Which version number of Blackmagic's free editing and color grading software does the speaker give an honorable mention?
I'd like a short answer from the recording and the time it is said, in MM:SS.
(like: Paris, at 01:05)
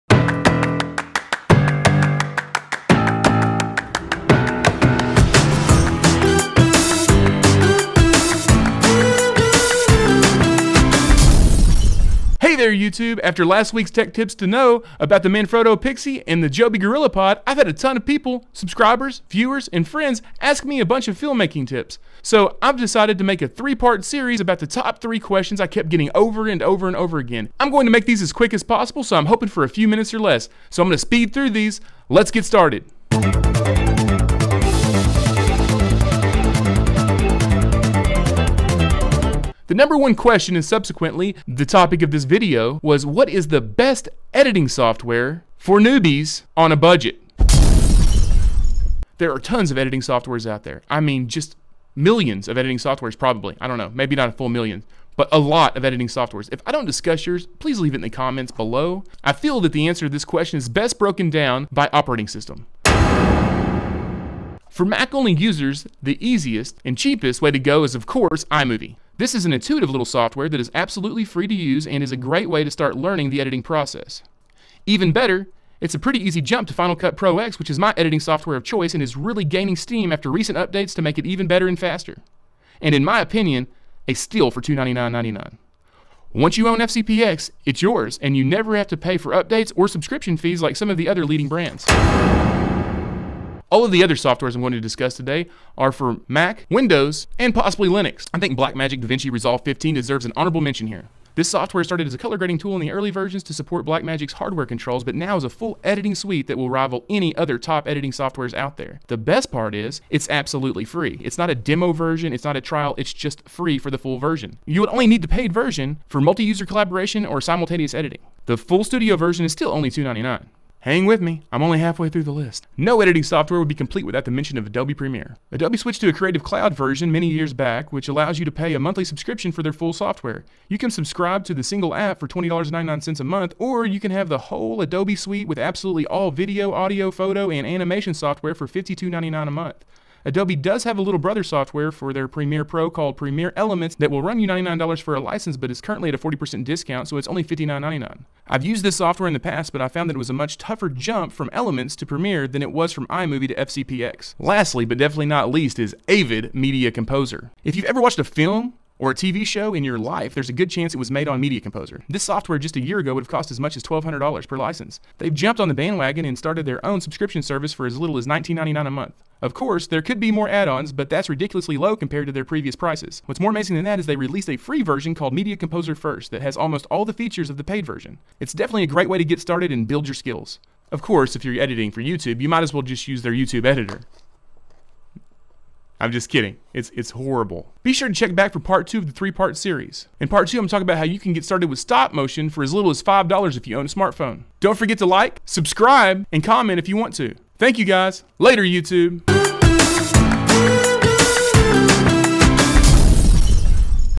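15, at 01:39.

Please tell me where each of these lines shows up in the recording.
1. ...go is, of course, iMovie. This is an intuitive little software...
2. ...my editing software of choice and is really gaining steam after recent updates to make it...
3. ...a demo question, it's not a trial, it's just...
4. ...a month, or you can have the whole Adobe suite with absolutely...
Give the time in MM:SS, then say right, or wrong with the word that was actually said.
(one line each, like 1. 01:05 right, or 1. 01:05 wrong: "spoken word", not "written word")
1. 01:07 right
2. 01:17 right
3. 01:51 wrong: "version", not "question"
4. 02:13 right.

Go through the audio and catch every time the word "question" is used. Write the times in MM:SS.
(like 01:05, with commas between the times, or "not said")
00:25, 00:40, 01:00.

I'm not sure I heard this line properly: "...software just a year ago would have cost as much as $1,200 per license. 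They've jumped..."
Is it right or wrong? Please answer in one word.
right.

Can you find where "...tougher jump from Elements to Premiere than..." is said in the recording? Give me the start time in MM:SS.
02:30.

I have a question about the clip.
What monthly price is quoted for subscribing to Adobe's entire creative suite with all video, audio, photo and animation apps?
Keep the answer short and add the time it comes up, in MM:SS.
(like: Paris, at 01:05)
$52.99, at 02:18.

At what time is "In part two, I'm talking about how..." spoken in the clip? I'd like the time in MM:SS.
03:10.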